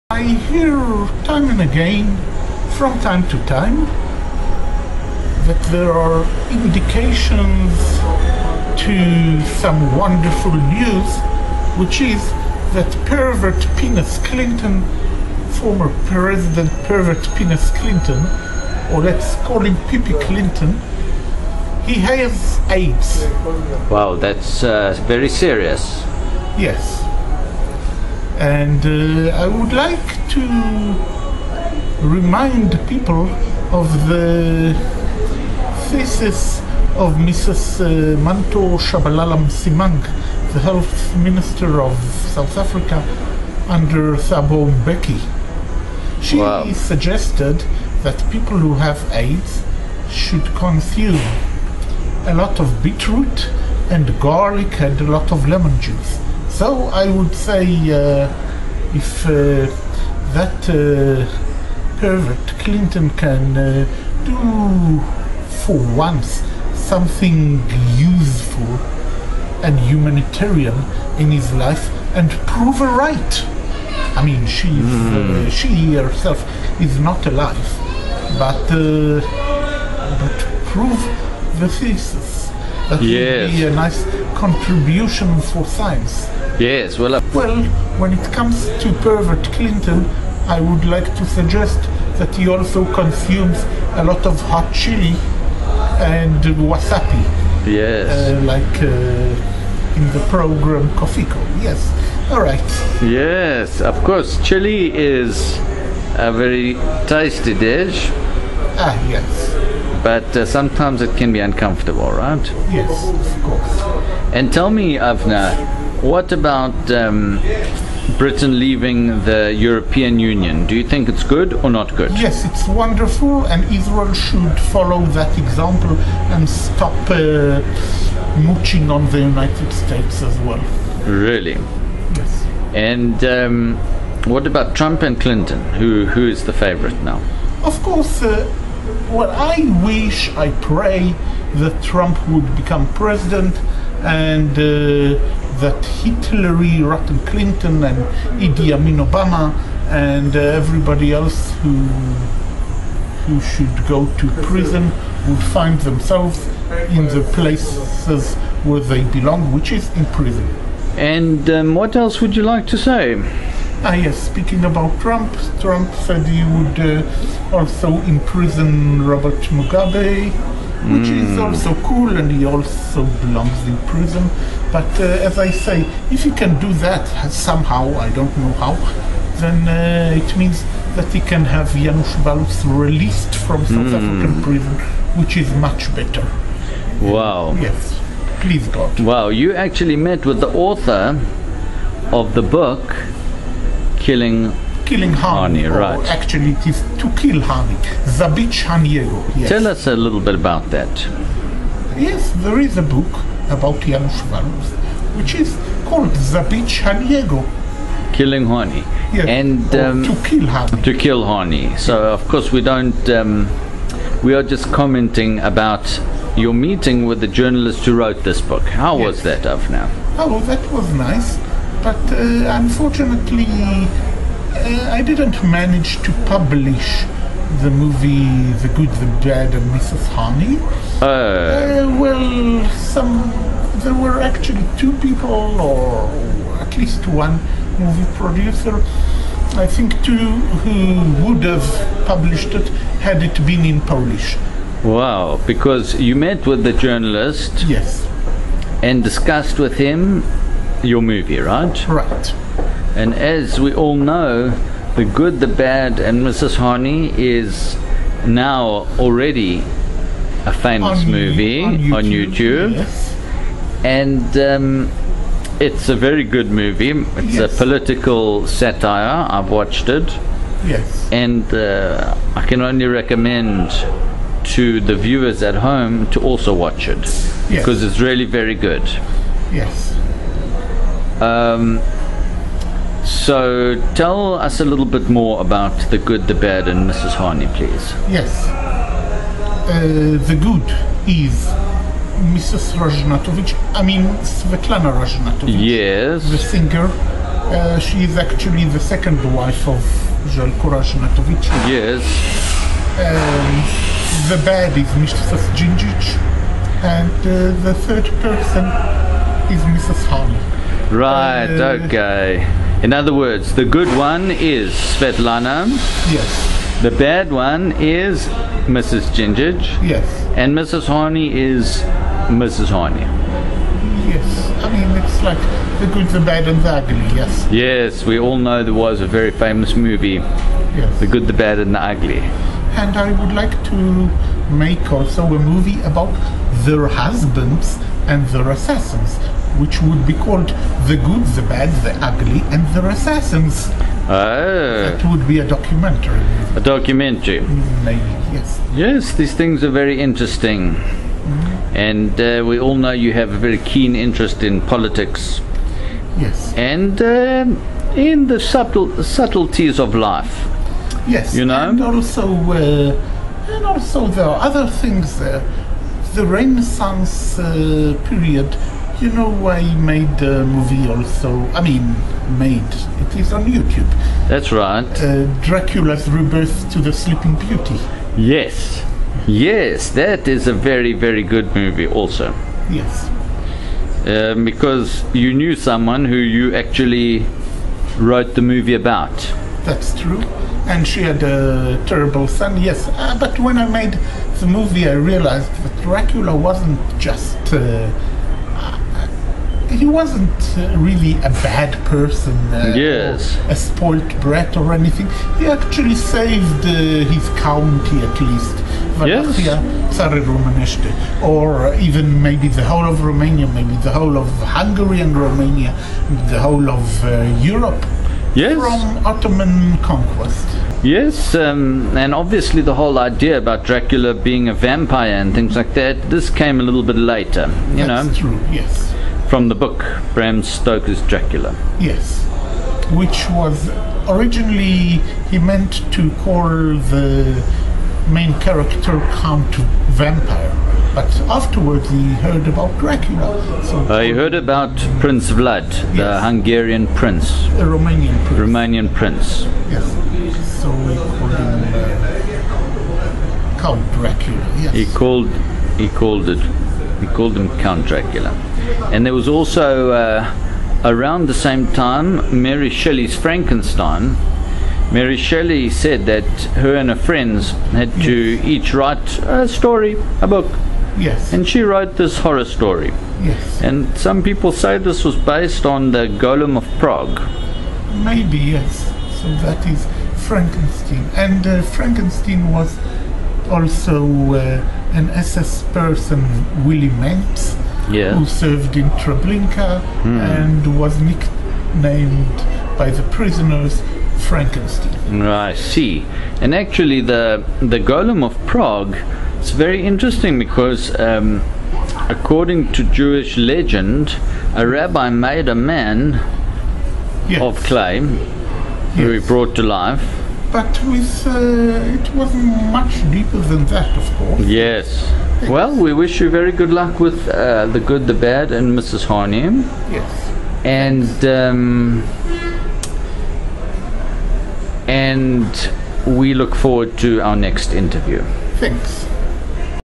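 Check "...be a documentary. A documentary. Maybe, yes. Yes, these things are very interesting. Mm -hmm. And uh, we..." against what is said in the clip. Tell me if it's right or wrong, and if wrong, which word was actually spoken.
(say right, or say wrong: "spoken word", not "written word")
right.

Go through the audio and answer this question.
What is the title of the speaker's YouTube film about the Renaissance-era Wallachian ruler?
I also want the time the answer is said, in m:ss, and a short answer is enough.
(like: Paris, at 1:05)
Dracula's Rebirth to the Sleeping Beauty, at 6:15.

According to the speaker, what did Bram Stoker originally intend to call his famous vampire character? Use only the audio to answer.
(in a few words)
Count Vampire.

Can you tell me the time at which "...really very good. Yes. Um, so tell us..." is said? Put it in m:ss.
4:38.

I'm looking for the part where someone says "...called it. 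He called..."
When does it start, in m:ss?
7:35.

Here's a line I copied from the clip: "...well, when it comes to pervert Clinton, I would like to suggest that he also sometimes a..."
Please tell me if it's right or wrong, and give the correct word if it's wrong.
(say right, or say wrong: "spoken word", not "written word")
wrong: "consumes", not "sometimes".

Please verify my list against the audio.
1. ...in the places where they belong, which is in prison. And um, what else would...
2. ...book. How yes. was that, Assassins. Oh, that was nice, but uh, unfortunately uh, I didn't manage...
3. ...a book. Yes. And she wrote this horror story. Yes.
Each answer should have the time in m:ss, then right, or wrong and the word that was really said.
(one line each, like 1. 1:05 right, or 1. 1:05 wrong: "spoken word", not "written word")
1. 2:36 right
2. 3:38 wrong: "Now", not "Assassins"
3. 7:50 right.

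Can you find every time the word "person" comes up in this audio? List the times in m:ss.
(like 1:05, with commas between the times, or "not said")
5:08, 6:41, 8:05.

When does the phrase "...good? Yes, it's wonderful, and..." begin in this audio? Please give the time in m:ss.
2:01.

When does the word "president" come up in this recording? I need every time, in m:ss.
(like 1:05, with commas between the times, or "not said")
0:16, 2:22.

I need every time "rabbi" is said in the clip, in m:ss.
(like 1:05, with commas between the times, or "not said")
8:24.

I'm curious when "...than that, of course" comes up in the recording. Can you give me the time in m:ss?
8:33.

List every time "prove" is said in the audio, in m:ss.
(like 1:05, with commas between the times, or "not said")
1:12, 1:20.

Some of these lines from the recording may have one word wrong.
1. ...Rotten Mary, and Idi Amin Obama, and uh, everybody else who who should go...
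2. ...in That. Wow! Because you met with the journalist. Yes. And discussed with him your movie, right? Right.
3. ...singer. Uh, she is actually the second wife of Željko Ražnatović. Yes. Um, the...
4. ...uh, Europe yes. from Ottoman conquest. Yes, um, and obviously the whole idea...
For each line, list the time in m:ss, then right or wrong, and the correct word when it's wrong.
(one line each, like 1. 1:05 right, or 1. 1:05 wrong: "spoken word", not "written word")
1. 2:26 wrong: "Clinton", not "Mary"
2. 4:03 wrong: "Polish", not "That"
3. 4:56 right
4. 6:57 right.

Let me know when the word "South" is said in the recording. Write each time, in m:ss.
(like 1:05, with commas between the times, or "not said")
0:42, 3:03.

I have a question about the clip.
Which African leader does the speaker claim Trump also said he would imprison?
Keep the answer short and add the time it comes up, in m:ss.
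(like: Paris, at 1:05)
Robert Mugabe, at 2:49.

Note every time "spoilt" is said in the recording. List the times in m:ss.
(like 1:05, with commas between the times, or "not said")
6:43.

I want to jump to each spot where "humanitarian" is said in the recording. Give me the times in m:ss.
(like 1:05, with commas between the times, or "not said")
1:09.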